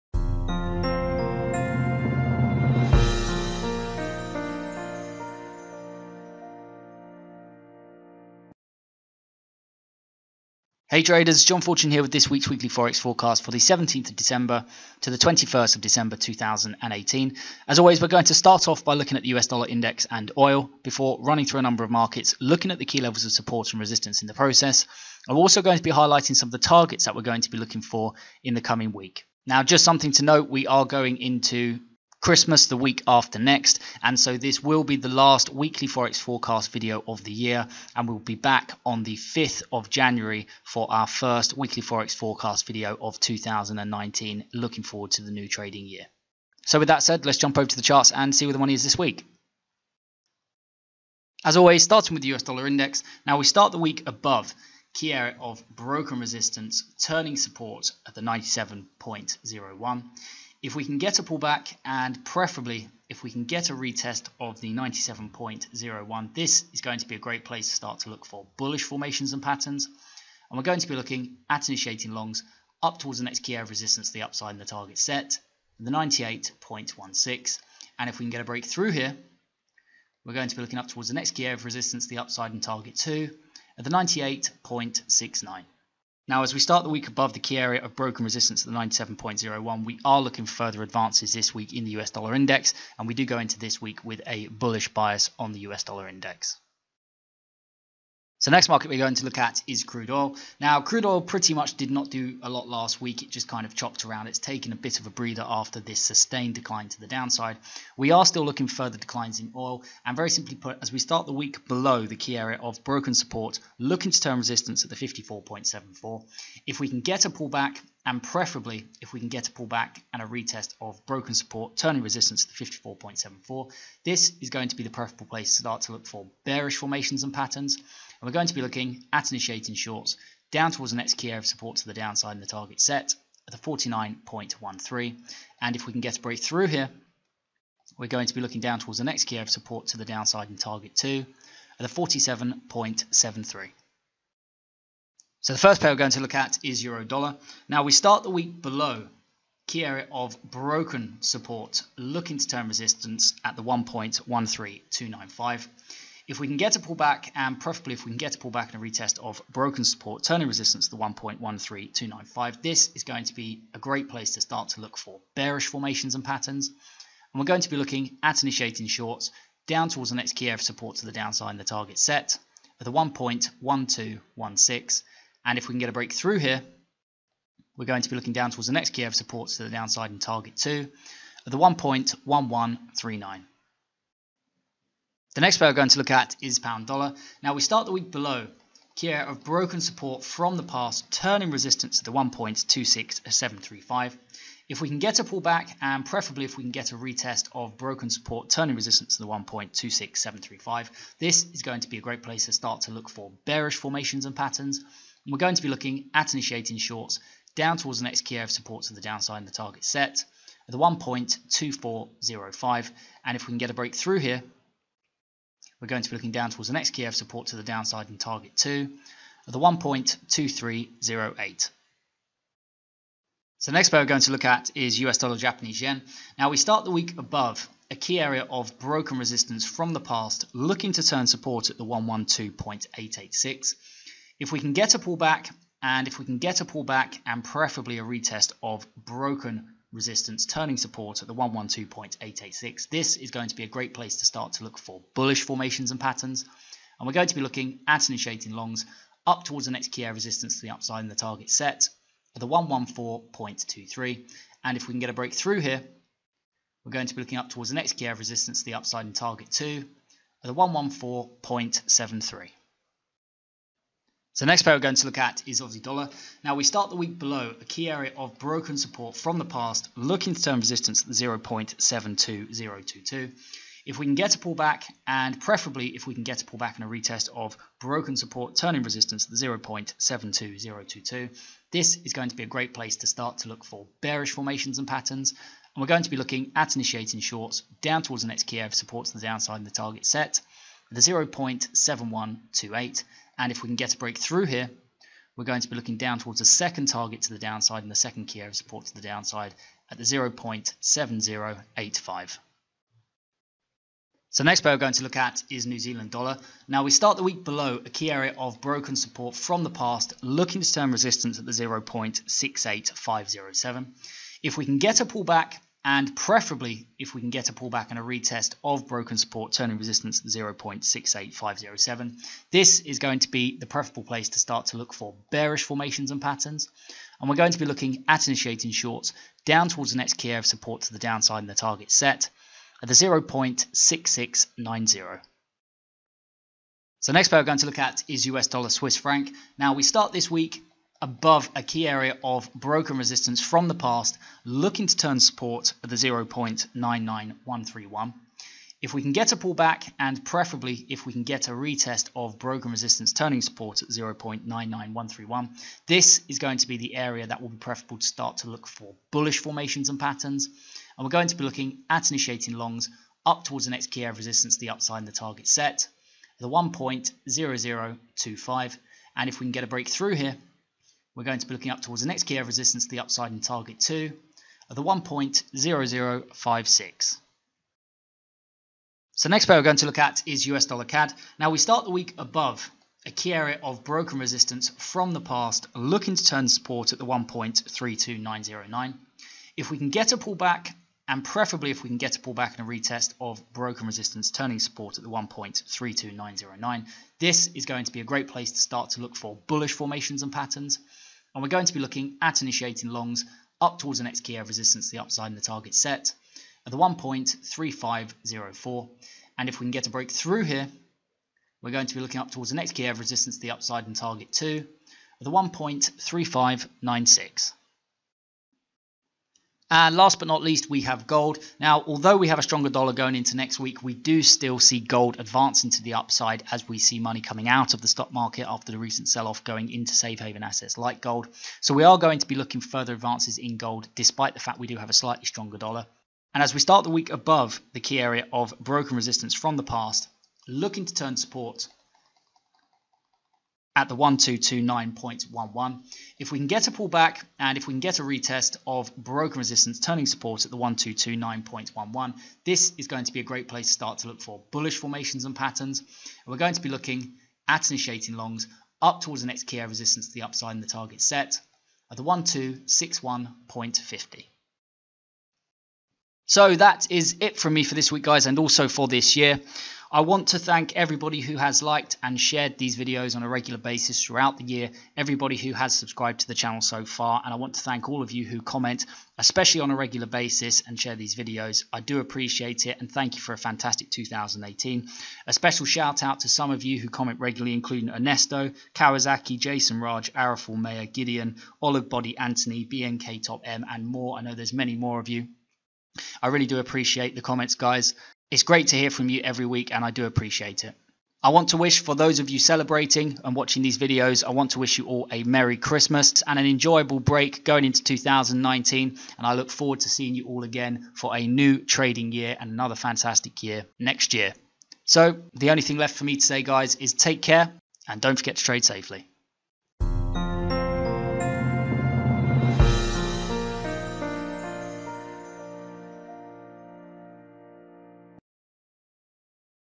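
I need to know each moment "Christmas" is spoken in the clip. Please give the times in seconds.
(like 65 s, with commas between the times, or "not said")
32 s, 505 s.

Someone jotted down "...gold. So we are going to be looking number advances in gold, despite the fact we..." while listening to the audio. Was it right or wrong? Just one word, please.
wrong.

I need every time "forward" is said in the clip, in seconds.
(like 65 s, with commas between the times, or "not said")
44 s, 509 s.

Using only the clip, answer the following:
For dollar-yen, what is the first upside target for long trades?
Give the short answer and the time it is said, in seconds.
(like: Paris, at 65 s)
114.23, at 252 s.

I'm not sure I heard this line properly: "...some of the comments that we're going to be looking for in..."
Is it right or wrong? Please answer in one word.
wrong.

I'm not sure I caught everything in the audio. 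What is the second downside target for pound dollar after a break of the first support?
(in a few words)
1.2308.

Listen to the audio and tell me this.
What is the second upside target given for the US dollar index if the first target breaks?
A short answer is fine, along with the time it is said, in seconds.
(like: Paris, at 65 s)
98.69, at 83 s.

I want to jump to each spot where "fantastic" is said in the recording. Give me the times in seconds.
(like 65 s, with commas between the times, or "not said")
483 s, 512 s.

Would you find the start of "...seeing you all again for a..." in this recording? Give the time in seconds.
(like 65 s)
509 s.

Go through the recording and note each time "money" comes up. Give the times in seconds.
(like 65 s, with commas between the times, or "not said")
48 s, 426 s.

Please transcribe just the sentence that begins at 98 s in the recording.
So next market we're going to look at is crude oil.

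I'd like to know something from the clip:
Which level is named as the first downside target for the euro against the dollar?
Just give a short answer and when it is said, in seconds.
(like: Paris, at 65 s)
1.1216, at 172 s.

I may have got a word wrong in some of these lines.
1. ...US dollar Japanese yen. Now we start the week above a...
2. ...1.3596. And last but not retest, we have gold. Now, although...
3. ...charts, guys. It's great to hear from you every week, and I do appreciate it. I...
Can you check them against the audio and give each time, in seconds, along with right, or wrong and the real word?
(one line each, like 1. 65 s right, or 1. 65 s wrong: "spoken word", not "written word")
1. 225 s right
2. 415 s wrong: "least", not "retest"
3. 497 s wrong: "comments", not "charts".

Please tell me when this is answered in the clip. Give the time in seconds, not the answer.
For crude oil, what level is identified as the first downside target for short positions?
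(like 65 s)
133 s.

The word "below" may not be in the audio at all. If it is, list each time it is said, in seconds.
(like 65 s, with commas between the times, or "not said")
111 s, 148 s, 188 s, 267 s, 307 s.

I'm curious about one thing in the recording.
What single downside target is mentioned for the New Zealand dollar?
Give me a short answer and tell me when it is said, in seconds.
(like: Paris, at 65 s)
0.6690, at 332 s.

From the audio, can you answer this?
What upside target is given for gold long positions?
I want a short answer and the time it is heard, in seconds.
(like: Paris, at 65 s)
1261.50, at 462 s.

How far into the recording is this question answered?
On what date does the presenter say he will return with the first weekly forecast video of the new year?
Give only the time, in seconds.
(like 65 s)
39 s.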